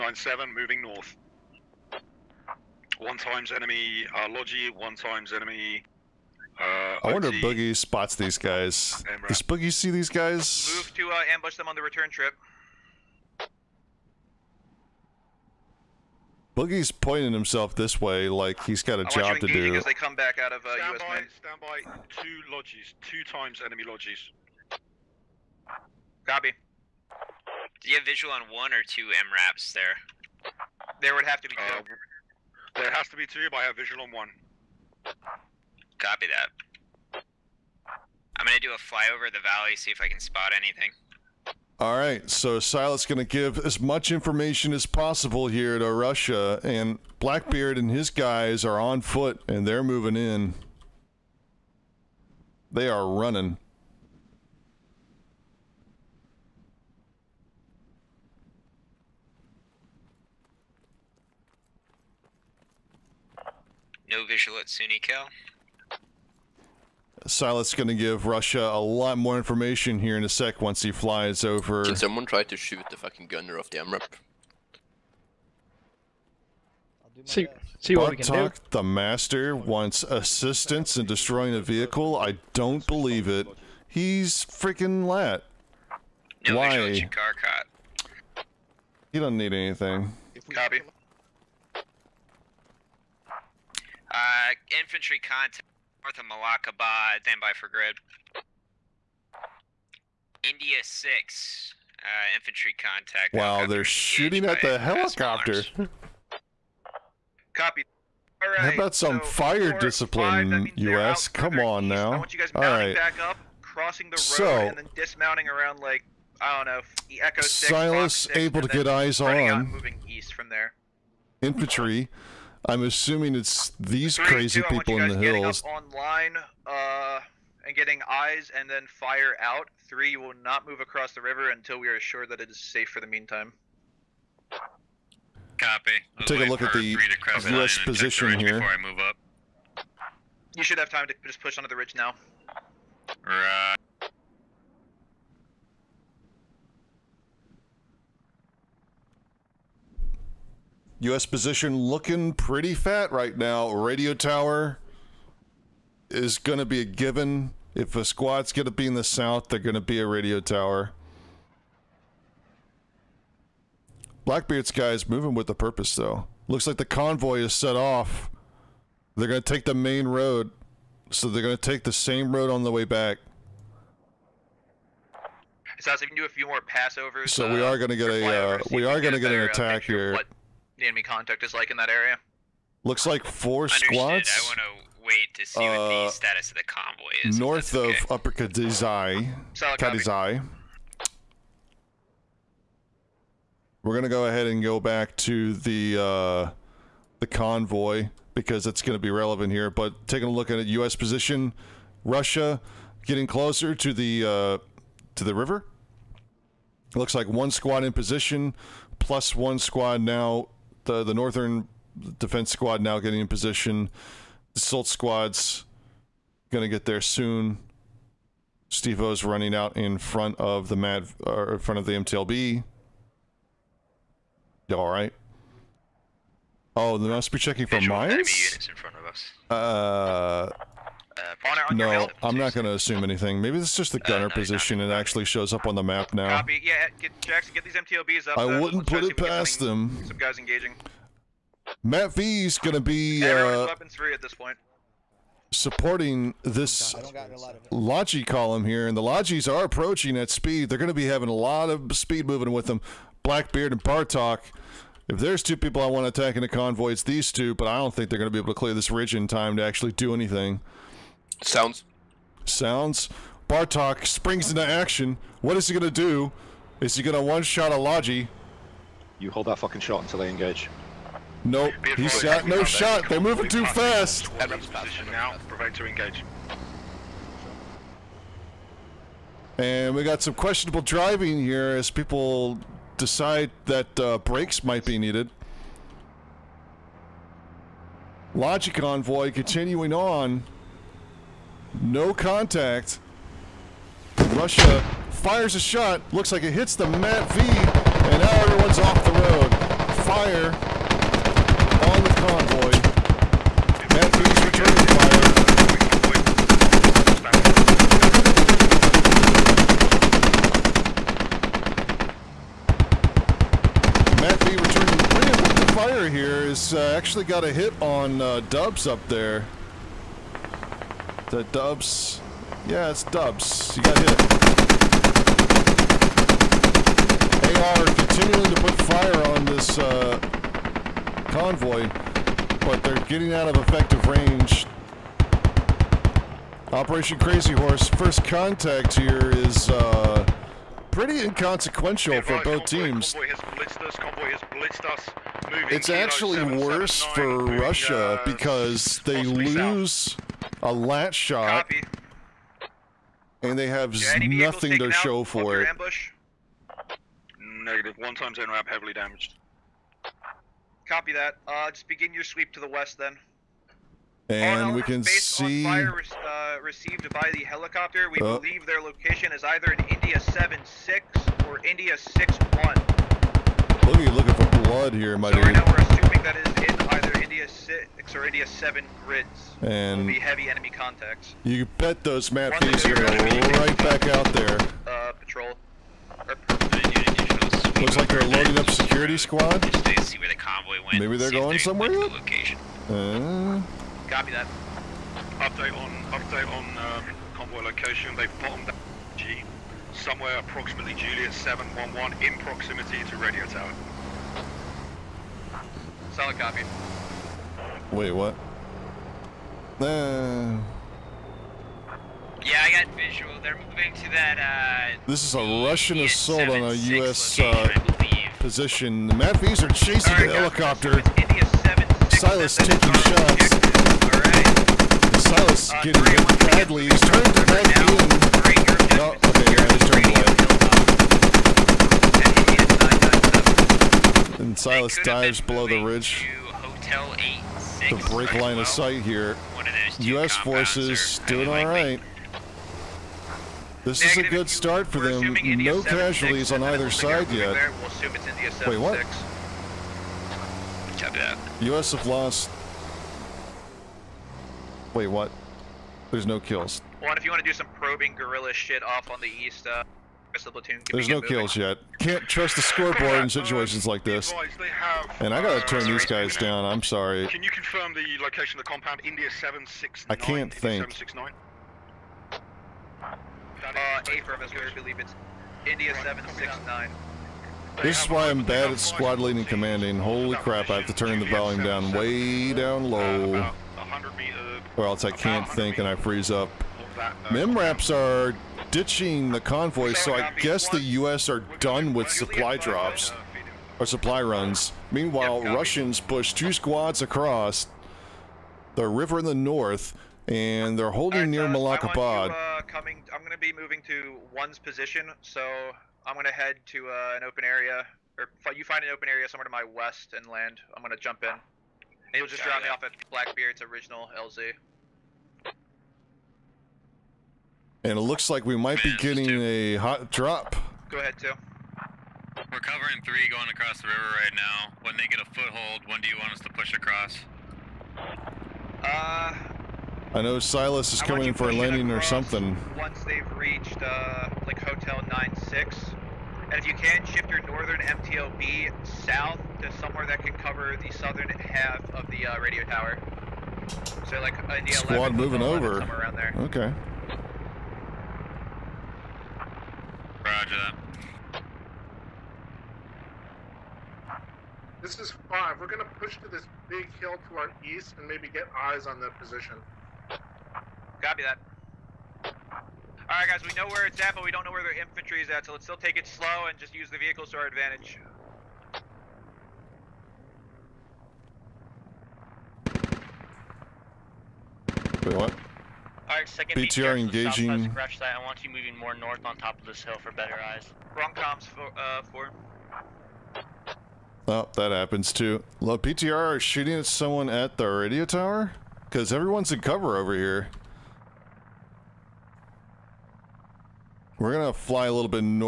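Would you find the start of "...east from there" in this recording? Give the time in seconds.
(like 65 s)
120 s.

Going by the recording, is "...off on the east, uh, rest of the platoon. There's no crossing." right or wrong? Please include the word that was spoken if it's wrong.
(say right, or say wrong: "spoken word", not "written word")
wrong: "moving", not "crossing".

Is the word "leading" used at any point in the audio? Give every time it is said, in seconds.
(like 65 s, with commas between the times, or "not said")
479 s.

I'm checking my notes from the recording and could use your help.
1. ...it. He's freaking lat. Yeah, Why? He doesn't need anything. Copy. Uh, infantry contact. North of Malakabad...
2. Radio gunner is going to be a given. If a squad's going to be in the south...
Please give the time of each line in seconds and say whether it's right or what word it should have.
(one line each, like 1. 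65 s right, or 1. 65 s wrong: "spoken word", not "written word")
1. 83 s right
2. 153 s wrong: "tower", not "gunner".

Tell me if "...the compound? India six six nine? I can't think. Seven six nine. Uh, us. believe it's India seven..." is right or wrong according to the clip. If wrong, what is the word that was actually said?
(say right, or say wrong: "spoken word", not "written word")
wrong: "seven", not "six".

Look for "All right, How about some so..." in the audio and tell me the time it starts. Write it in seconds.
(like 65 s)
108 s.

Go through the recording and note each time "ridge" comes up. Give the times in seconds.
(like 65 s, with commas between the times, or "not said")
141 s, 258 s, 435 s.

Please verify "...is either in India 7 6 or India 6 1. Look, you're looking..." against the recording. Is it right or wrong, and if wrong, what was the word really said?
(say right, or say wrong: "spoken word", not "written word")
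right.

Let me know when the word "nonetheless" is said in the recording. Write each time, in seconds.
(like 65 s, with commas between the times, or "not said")
not said.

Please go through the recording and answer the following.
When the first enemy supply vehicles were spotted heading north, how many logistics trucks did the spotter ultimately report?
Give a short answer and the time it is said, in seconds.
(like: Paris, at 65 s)
2, at 23 s.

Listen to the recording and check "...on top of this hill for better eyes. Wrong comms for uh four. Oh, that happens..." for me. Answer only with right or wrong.
right.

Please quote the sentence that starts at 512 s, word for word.
And will just drop me off at Blackbeard's original LZ.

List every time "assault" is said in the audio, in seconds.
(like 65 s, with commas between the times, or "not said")
214 s, 415 s.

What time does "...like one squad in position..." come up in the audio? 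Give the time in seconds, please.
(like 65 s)
207 s.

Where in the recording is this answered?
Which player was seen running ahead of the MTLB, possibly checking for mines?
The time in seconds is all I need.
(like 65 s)
218 s.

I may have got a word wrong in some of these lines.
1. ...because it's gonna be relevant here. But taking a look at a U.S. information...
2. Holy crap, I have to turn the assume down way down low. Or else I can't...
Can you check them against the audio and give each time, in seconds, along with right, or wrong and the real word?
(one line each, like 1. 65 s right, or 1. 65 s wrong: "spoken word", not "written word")
1. 198 s wrong: "position", not "information"
2. 479 s wrong: "volume", not "assume".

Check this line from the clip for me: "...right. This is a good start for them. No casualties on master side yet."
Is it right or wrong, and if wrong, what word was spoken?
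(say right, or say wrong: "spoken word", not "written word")
wrong: "either", not "master".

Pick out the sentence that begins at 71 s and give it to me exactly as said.
Can someone try to shoot the fucking gunner off the MRAP?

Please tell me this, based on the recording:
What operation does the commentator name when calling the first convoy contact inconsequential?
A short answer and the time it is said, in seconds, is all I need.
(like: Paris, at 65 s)
Operation Crazy Horse, at 336 s.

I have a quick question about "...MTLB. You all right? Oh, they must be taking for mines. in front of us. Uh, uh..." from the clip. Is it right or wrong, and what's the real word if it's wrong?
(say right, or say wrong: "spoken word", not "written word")
wrong: "checking", not "taking".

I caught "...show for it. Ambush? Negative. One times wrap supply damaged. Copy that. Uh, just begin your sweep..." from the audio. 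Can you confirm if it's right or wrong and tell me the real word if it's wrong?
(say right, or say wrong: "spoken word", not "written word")
wrong: "heavily", not "supply".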